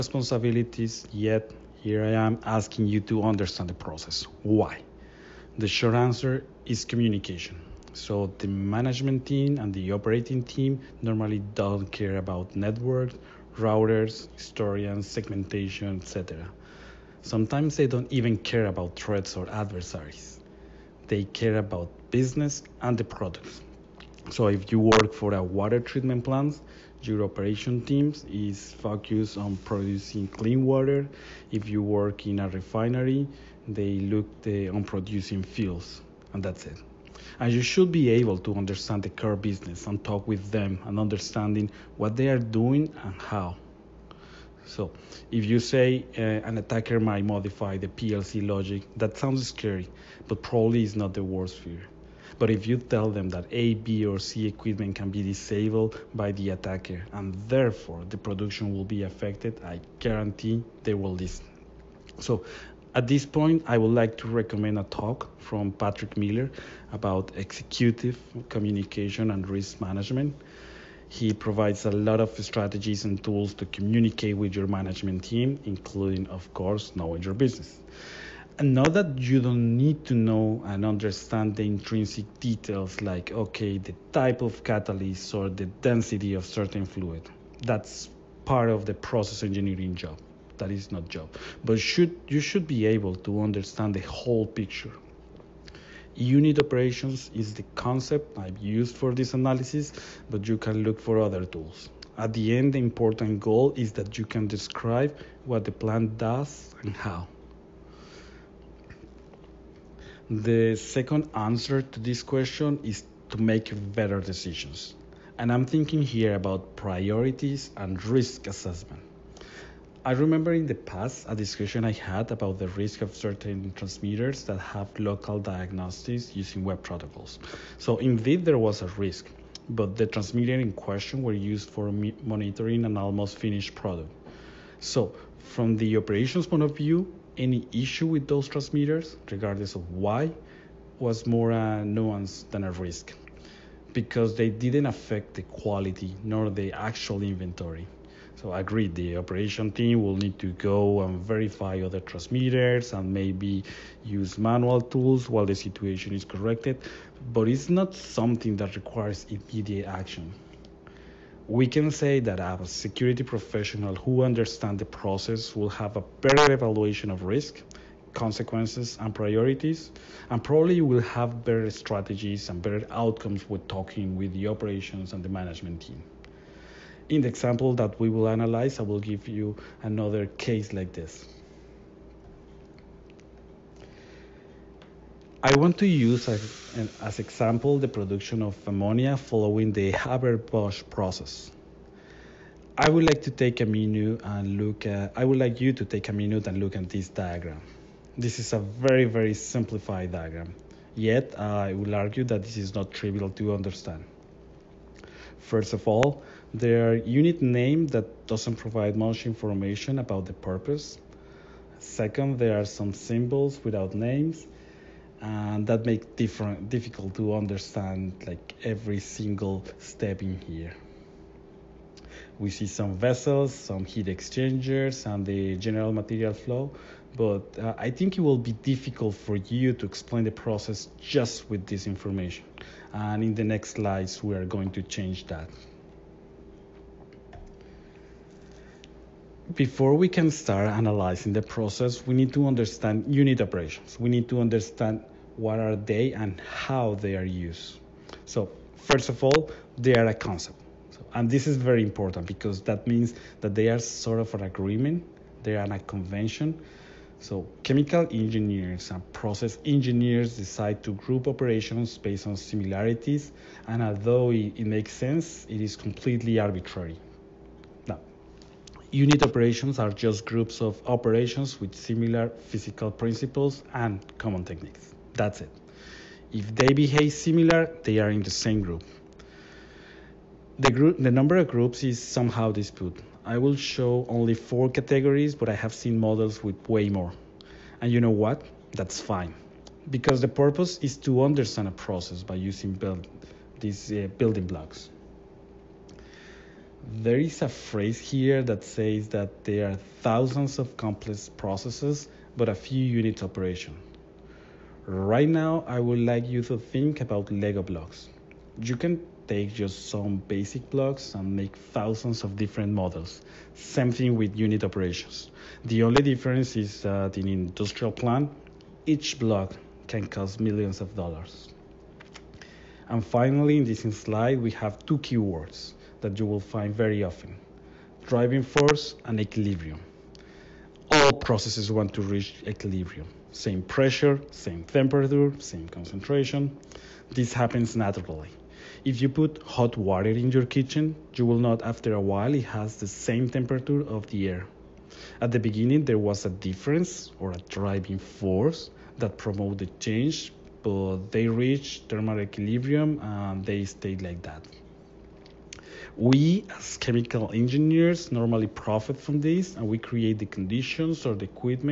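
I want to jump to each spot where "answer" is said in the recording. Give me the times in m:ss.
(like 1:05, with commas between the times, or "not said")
0:05, 1:51.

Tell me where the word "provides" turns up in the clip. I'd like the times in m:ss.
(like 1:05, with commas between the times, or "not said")
1:11, 3:28.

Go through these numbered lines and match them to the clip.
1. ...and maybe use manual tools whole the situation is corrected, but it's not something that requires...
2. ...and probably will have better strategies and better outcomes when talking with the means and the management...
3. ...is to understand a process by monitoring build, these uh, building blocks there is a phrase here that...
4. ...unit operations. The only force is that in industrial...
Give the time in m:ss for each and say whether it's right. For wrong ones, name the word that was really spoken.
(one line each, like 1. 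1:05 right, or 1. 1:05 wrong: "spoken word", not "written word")
1. 2:32 wrong: "while", not "whole"
2. 2:50 wrong: "operations", not "means"
3. 4:50 wrong: "using", not "monitoring"
4. 5:14 wrong: "difference", not "force".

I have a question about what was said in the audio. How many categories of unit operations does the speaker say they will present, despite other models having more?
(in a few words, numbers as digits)
4.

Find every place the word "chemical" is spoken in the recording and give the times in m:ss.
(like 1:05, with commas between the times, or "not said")
4:17, 5:56.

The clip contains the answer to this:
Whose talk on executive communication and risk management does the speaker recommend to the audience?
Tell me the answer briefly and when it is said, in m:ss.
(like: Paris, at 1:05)
Patrick Miller, at 1:05.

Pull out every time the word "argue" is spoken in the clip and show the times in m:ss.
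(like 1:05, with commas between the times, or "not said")
3:21.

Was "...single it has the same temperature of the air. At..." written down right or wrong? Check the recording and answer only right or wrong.
wrong.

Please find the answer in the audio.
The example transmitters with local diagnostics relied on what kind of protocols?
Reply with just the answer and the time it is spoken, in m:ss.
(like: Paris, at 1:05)
web protocols, at 2:06.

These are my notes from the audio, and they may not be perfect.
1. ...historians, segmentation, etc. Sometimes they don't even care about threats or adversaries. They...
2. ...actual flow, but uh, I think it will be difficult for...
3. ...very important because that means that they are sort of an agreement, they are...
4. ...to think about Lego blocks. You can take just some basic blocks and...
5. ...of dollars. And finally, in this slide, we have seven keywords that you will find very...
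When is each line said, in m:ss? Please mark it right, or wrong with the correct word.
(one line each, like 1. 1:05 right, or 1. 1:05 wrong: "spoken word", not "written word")
1. 0:14 right
2. 3:45 wrong: "material", not "actual"
3. 4:11 right
4. 5:06 right
5. 5:20 wrong: "two", not "seven".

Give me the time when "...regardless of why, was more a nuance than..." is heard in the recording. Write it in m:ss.
2:19.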